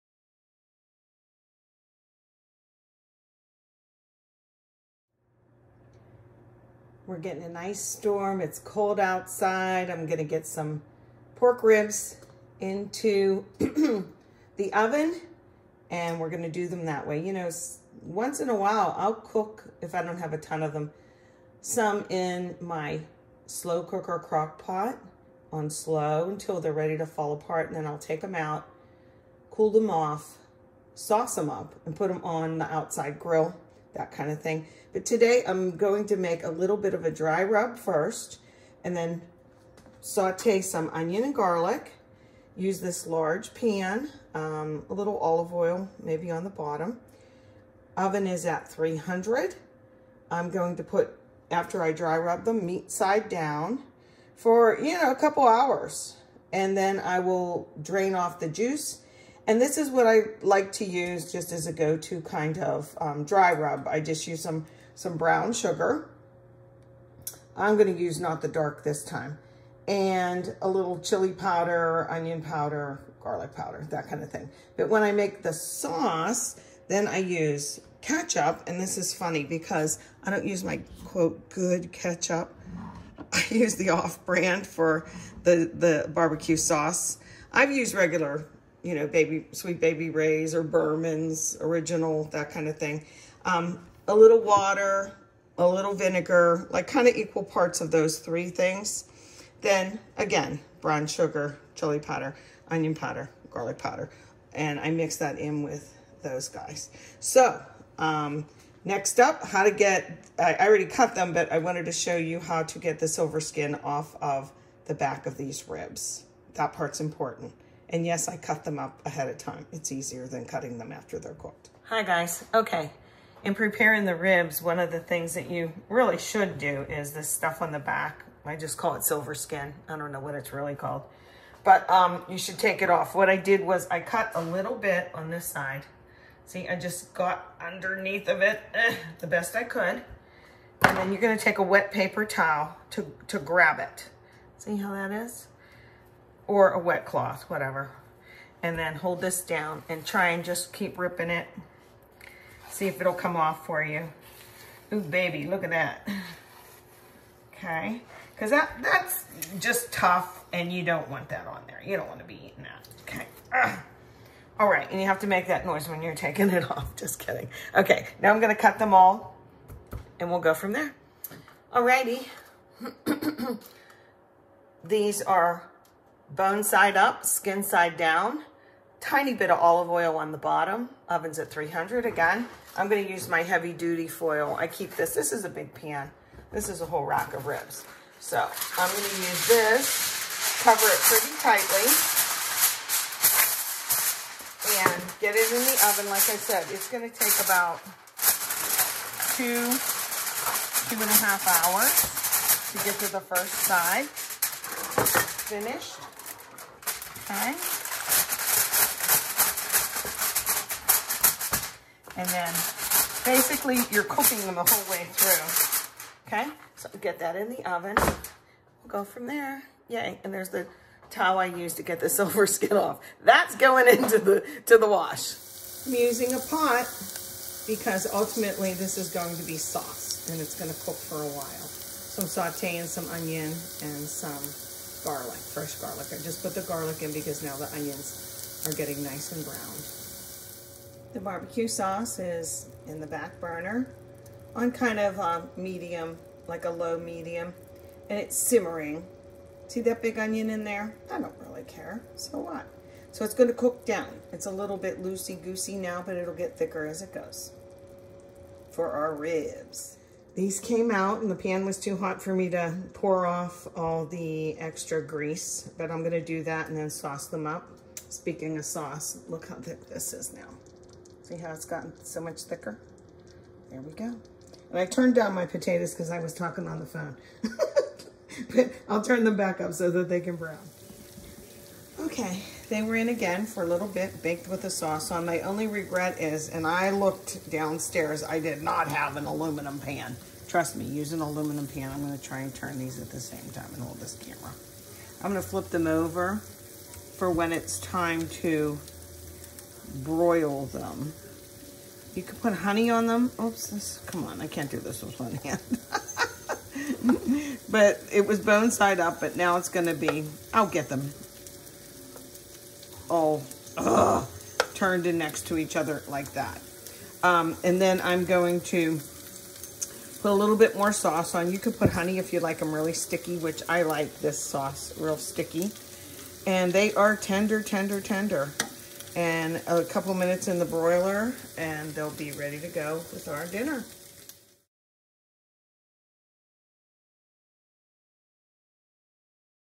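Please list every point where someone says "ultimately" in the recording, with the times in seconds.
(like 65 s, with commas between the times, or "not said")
228 s.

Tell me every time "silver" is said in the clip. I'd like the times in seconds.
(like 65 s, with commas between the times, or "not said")
113 s, 129 s, 222 s.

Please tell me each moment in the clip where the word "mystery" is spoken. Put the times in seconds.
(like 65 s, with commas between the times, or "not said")
not said.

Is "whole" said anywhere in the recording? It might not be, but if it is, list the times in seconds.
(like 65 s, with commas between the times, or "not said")
186 s, 214 s.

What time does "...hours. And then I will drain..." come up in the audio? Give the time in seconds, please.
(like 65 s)
55 s.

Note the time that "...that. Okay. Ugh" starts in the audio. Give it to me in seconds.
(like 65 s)
162 s.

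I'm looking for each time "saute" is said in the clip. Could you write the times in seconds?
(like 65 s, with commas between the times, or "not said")
40 s, 232 s.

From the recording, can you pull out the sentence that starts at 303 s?
Oops, this, come on, I can't do this with one hand.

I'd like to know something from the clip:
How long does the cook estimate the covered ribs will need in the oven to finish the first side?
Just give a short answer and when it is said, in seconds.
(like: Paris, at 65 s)
2 to 2.5 hours, at 199 s.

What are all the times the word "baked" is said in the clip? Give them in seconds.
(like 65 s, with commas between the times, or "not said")
284 s.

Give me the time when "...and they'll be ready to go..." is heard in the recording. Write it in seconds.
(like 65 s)
331 s.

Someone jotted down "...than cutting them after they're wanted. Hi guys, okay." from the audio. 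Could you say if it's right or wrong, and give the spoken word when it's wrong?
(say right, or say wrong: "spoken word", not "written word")
wrong: "cooked", not "wanted".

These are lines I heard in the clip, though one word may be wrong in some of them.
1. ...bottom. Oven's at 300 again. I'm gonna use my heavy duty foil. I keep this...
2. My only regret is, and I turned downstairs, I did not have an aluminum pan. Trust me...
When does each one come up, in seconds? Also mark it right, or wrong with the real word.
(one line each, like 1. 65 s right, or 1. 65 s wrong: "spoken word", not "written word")
1. 180 s right
2. 285 s wrong: "looked", not "turned".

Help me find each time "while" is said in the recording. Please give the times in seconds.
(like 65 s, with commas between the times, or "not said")
18 s, 231 s.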